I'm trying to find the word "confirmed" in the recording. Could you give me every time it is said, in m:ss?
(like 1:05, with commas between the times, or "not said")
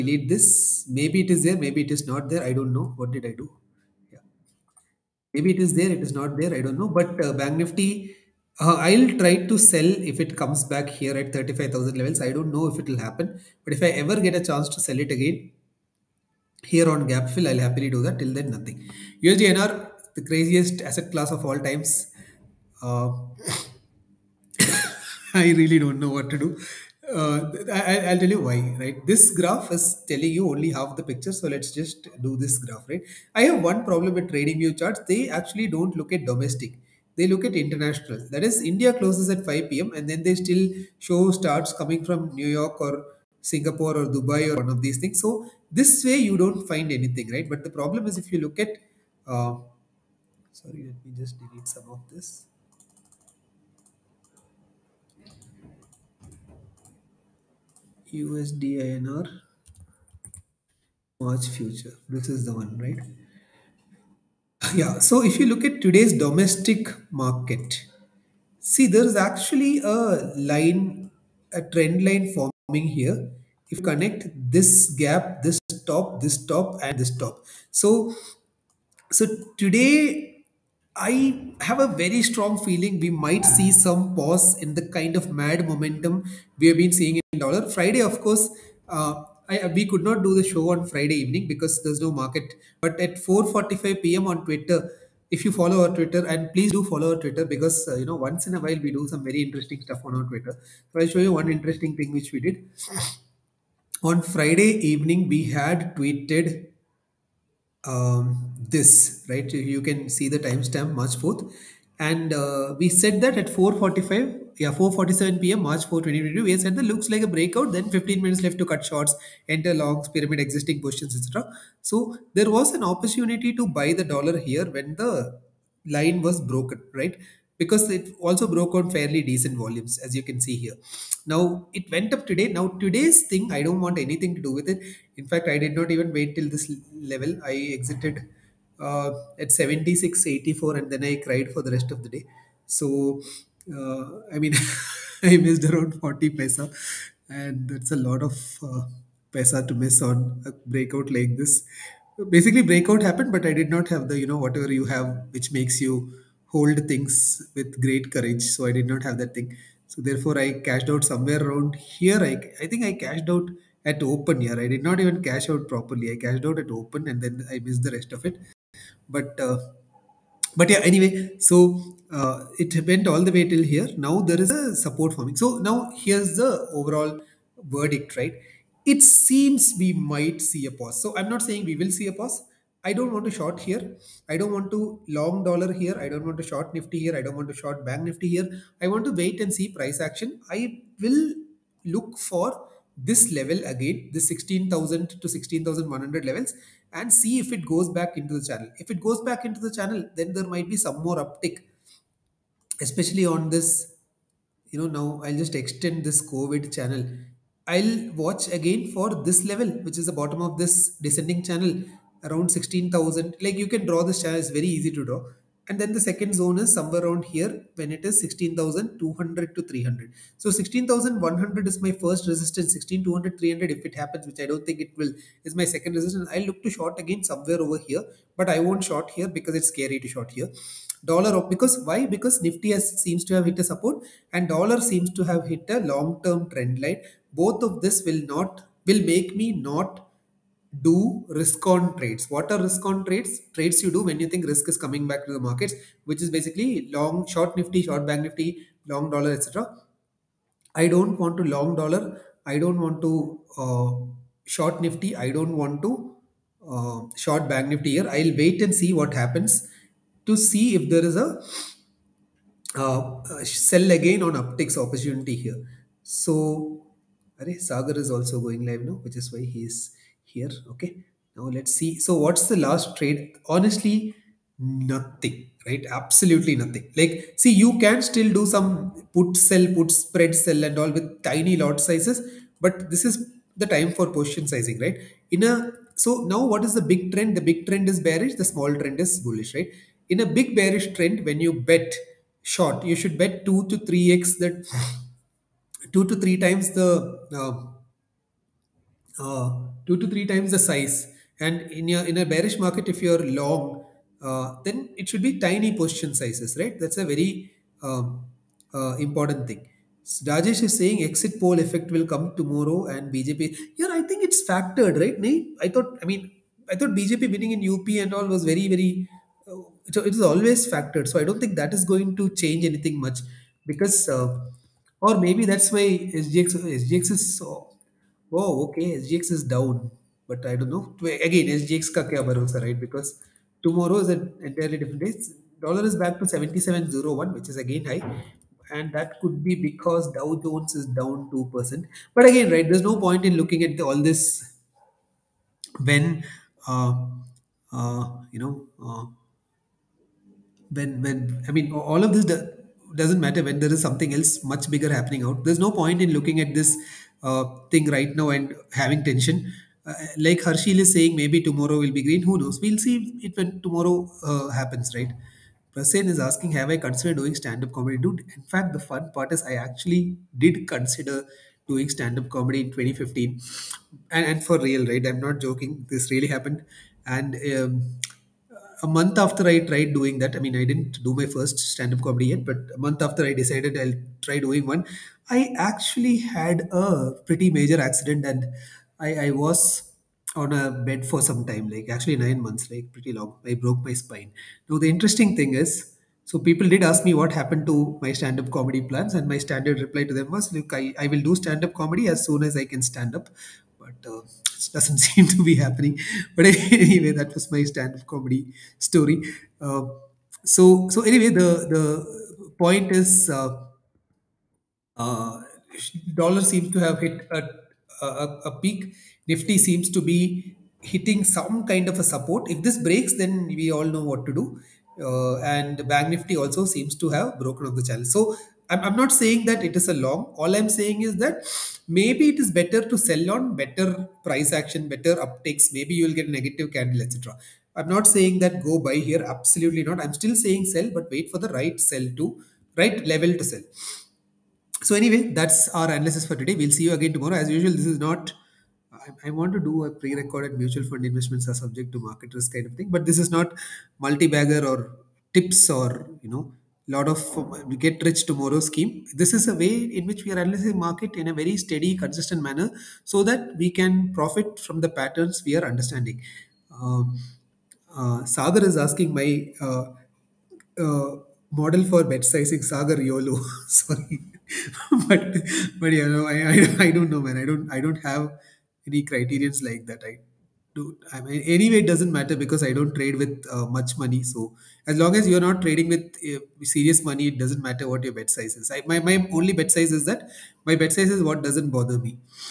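not said.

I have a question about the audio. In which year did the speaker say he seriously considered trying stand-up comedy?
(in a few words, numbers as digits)
2015.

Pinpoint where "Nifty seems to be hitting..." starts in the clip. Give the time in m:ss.
6:59.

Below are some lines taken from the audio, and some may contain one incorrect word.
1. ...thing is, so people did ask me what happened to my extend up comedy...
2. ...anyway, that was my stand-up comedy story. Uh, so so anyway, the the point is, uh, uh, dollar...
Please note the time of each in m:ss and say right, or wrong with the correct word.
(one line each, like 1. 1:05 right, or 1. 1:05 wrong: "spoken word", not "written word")
1. 6:35 wrong: "stand", not "extend"
2. 6:46 right.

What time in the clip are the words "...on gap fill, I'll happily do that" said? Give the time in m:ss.
0:16.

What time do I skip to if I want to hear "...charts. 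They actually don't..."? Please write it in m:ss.
0:34.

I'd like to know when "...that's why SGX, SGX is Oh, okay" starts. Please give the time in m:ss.
5:25.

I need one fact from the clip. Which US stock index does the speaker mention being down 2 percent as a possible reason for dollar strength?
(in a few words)
Dow Jones.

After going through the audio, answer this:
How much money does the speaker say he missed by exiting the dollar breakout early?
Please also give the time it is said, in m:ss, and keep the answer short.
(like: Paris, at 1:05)
40 paisa, at 2:26.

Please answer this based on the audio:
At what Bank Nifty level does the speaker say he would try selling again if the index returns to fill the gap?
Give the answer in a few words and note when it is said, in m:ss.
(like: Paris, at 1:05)
35,000, at 0:11.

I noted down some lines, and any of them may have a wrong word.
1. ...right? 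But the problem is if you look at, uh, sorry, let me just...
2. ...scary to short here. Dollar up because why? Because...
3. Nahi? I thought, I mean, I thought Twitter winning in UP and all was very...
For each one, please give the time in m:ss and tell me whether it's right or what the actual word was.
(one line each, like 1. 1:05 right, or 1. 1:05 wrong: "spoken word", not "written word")
1. 0:47 right
2. 3:49 right
3. 5:15 wrong: "BJP", not "Twitter".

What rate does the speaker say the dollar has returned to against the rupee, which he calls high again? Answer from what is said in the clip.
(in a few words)
77.01.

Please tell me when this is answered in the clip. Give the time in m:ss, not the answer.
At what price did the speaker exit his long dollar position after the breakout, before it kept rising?
2:19.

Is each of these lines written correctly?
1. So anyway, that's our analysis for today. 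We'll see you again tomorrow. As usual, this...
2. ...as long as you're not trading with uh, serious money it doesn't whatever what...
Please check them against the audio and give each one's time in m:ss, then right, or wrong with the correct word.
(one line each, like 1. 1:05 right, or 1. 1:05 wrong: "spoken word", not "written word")
1. 7:24 right
2. 8:04 wrong: "matter", not "whatever".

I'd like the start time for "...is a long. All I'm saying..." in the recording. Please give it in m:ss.
7:09.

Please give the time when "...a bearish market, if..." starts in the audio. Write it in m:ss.
5:02.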